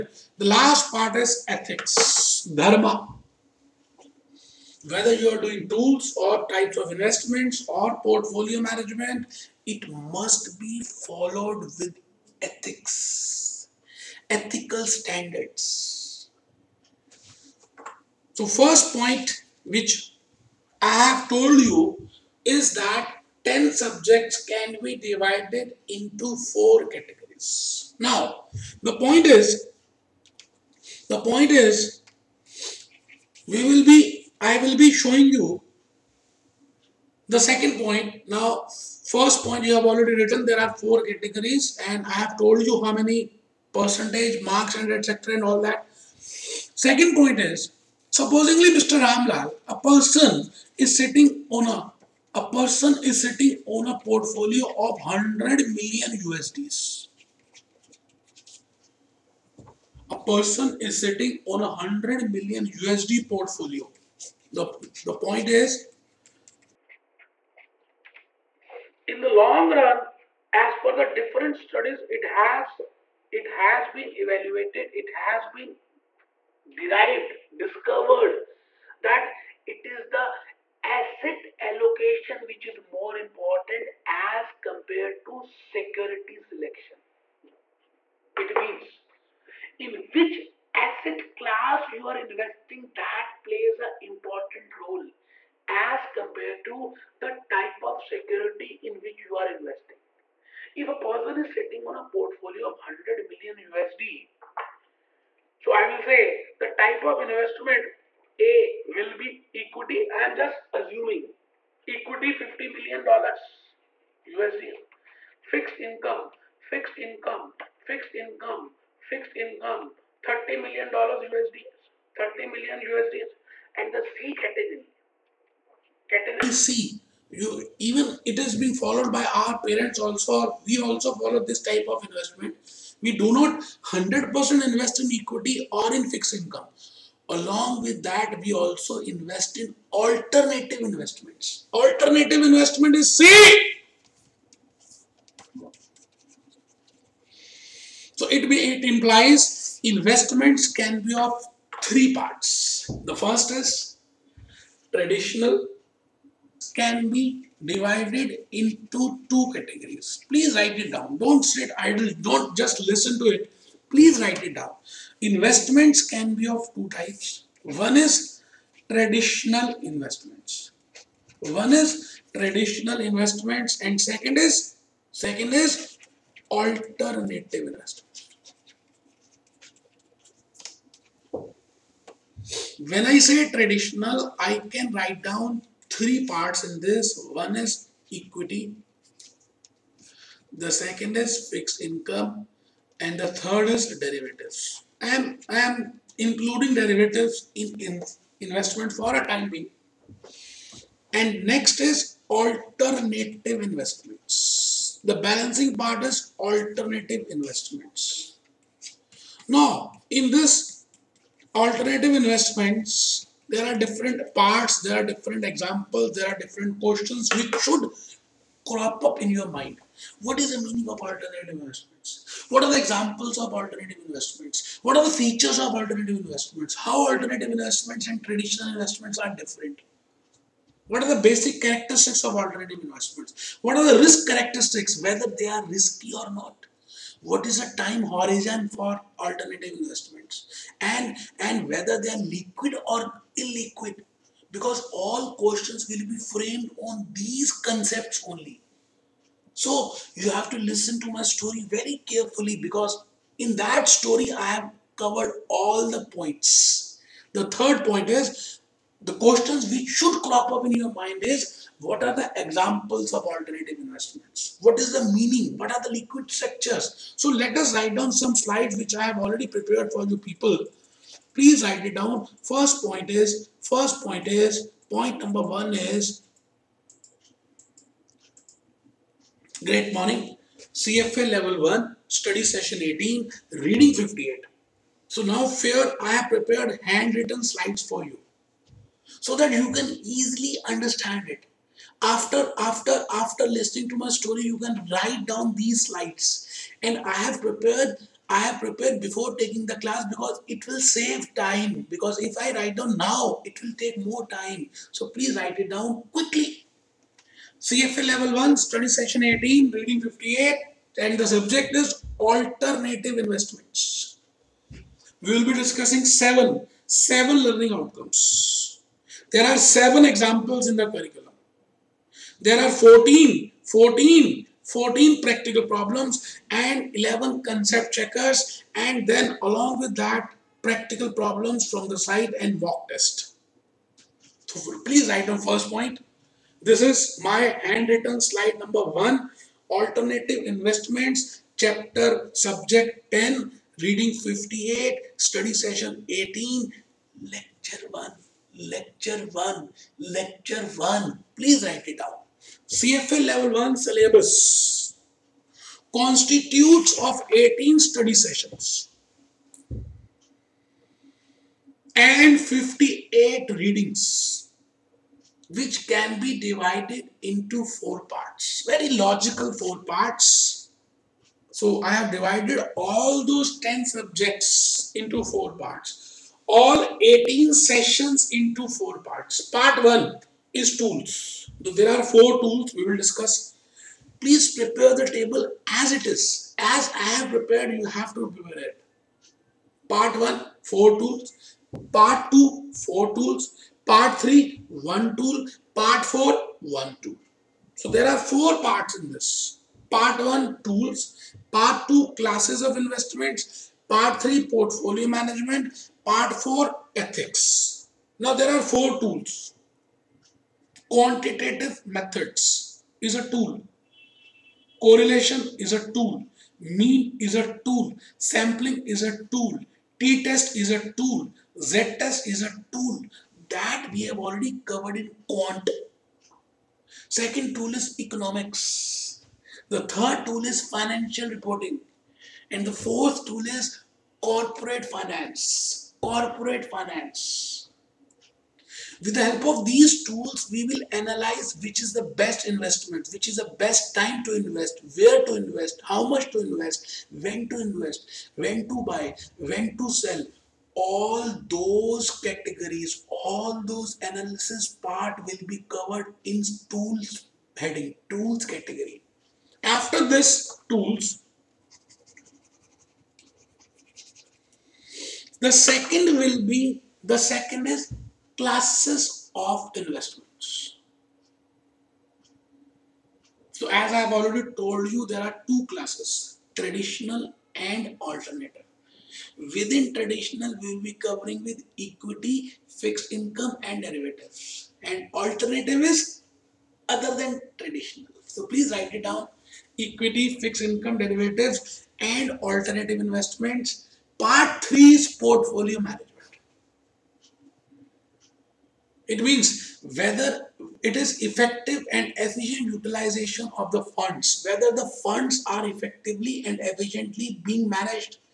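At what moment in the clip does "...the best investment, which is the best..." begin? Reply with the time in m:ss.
7:21.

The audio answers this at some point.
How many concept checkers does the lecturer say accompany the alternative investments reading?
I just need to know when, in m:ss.
5:26.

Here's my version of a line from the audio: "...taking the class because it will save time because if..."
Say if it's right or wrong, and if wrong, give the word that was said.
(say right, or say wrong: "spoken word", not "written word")
right.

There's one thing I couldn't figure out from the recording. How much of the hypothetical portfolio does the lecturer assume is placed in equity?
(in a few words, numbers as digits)
50 million dollars.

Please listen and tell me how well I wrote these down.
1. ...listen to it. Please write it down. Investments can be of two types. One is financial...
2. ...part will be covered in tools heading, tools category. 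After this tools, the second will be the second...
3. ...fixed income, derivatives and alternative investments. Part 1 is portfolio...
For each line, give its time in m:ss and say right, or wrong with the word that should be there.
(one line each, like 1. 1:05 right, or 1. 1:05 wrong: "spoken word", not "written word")
1. 2:42 wrong: "traditional", not "financial"
2. 7:34 right
3. 8:10 wrong: "3", not "1".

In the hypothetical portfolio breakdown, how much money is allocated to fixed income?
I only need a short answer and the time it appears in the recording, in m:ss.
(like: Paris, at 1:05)
30 million dollars, at 2:00.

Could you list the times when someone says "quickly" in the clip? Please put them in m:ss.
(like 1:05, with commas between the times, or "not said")
5:06.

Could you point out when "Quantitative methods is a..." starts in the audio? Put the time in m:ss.
6:50.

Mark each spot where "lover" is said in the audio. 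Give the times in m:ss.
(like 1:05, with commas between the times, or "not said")
not said.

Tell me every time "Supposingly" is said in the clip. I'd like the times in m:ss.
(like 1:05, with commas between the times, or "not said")
0:48.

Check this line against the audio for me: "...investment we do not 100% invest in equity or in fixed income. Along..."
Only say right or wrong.
right.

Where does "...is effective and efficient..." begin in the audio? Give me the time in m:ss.
8:20.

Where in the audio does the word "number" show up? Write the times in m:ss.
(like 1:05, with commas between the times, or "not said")
4:35, 5:38.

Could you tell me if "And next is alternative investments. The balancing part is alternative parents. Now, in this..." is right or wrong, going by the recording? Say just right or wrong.
wrong.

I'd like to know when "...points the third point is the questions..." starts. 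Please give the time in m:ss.
4:16.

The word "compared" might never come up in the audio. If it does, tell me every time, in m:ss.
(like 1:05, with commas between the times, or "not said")
1:24, 1:36.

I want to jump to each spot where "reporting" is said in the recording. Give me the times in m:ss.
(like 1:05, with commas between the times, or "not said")
7:11.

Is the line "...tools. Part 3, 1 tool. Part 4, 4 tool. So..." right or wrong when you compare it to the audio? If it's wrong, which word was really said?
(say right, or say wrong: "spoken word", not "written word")
wrong: "1", not "4".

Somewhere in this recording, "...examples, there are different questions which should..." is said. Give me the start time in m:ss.
3:35.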